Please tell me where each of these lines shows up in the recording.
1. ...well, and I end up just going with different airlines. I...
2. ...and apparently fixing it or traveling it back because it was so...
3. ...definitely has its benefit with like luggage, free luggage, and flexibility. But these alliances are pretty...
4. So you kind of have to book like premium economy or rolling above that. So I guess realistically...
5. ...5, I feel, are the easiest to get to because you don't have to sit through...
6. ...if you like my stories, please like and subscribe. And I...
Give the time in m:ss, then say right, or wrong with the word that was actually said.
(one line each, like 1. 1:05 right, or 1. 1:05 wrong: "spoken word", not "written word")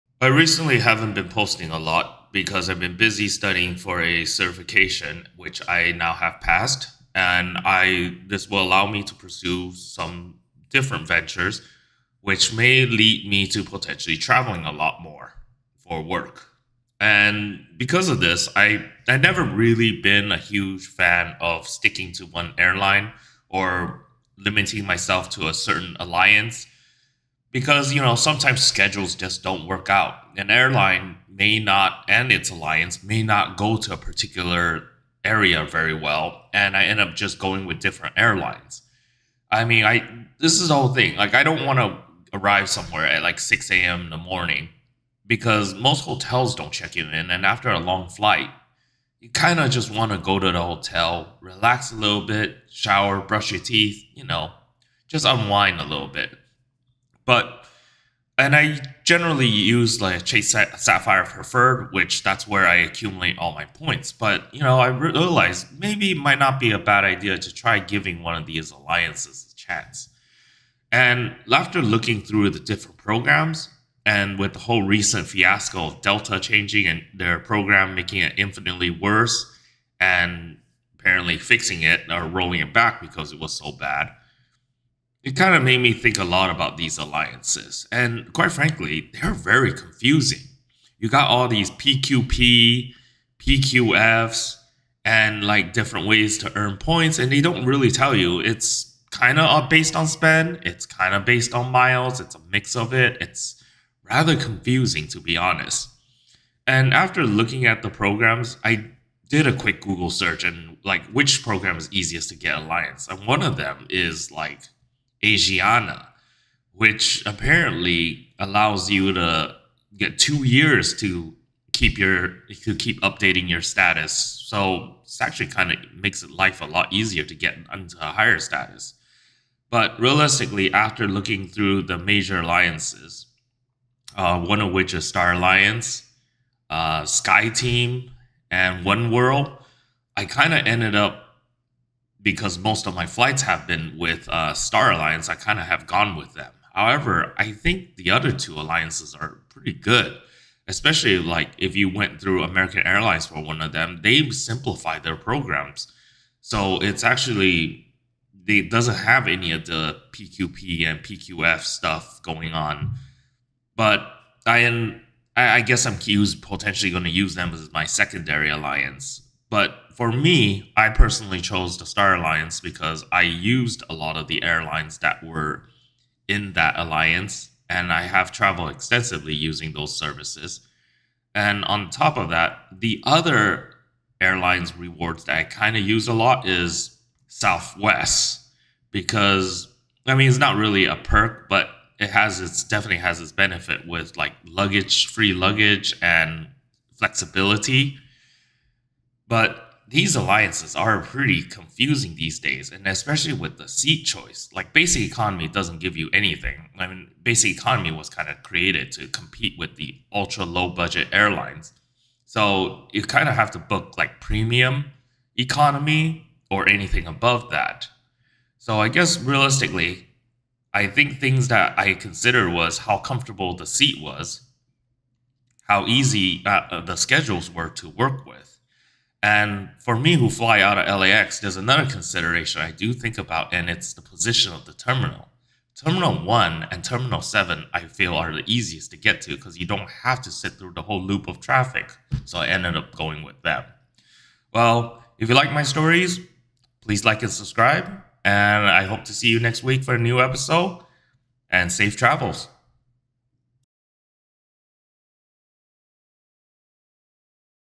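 1. 0:35 right
2. 1:19 wrong: "rolling", not "traveling"
3. 3:12 right
4. 3:32 wrong: "anything", not "rolling"
5. 3:57 wrong: "7", not "5"
6. 4:05 right.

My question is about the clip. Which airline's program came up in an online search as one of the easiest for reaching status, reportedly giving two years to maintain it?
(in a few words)
Asiana.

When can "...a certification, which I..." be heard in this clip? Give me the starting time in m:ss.
0:04.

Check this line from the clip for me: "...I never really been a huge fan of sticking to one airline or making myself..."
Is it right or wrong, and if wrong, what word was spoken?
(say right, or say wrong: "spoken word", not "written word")
wrong: "limiting", not "making".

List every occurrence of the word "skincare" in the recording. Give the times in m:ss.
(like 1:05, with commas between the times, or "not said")
not said.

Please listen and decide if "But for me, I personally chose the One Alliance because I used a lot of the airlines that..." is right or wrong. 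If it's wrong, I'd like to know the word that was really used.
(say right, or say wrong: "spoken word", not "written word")
wrong: "Star", not "One".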